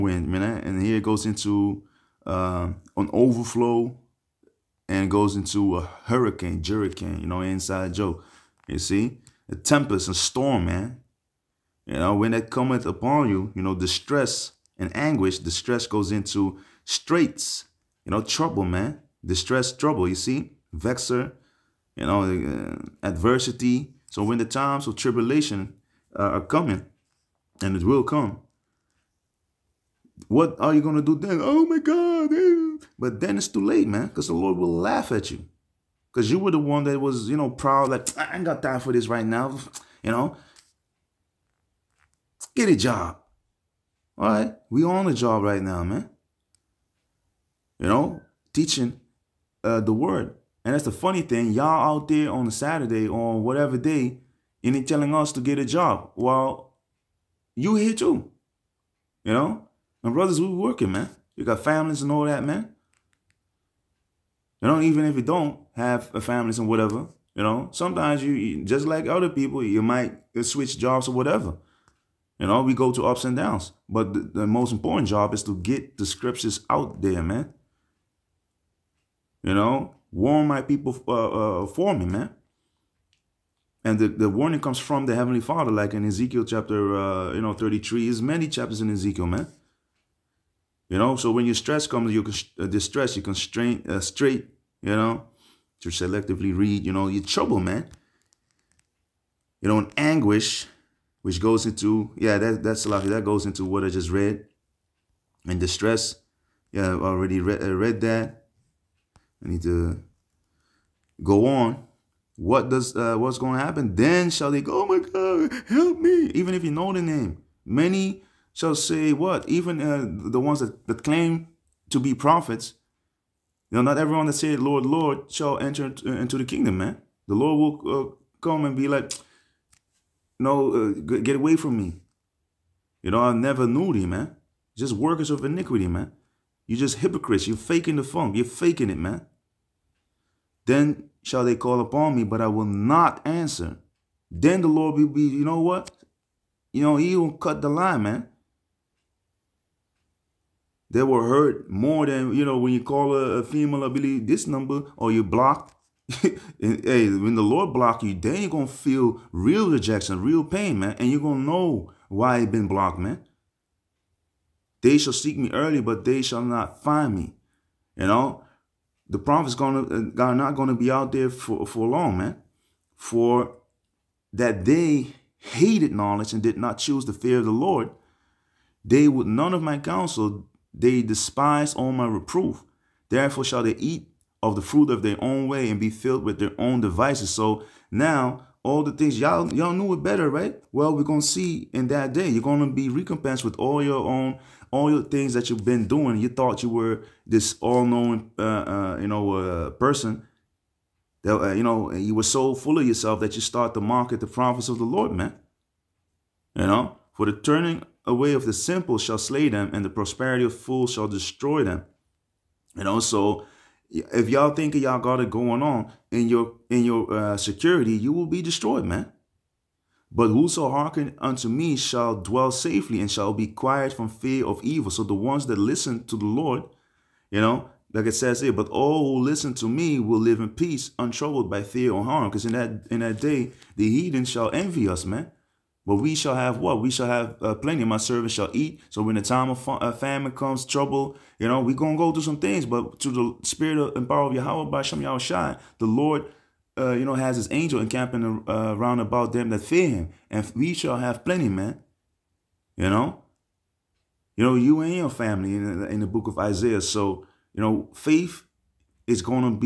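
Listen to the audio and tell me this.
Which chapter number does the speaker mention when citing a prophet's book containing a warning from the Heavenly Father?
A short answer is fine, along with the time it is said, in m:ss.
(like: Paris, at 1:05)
33, at 1:27.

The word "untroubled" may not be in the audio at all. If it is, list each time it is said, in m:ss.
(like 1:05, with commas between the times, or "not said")
3:50.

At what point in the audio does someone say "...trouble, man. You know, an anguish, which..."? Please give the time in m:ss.
1:37.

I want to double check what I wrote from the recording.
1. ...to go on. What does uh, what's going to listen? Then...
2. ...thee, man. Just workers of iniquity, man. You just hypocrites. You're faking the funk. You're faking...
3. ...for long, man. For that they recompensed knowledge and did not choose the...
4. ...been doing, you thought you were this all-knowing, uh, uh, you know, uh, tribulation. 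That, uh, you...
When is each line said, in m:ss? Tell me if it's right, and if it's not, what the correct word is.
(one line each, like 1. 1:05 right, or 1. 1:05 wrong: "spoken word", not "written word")
1. 1:49 wrong: "happen", not "listen"
2. 2:13 right
3. 2:51 wrong: "hated", not "recompensed"
4. 3:15 wrong: "person", not "tribulation".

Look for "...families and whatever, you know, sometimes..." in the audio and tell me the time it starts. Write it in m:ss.
1:06.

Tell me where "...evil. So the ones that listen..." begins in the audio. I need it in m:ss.
3:44.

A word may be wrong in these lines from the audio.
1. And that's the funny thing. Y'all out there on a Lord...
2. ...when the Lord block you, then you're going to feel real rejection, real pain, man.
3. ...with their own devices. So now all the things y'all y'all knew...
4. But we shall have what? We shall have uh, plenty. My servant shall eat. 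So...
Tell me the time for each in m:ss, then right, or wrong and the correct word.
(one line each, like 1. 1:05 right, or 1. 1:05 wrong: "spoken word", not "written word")
1. 0:50 wrong: "Saturday", not "Lord"
2. 2:36 right
3. 3:06 right
4. 3:55 right.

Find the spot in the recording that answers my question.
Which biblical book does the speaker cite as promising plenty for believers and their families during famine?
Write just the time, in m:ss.
4:16.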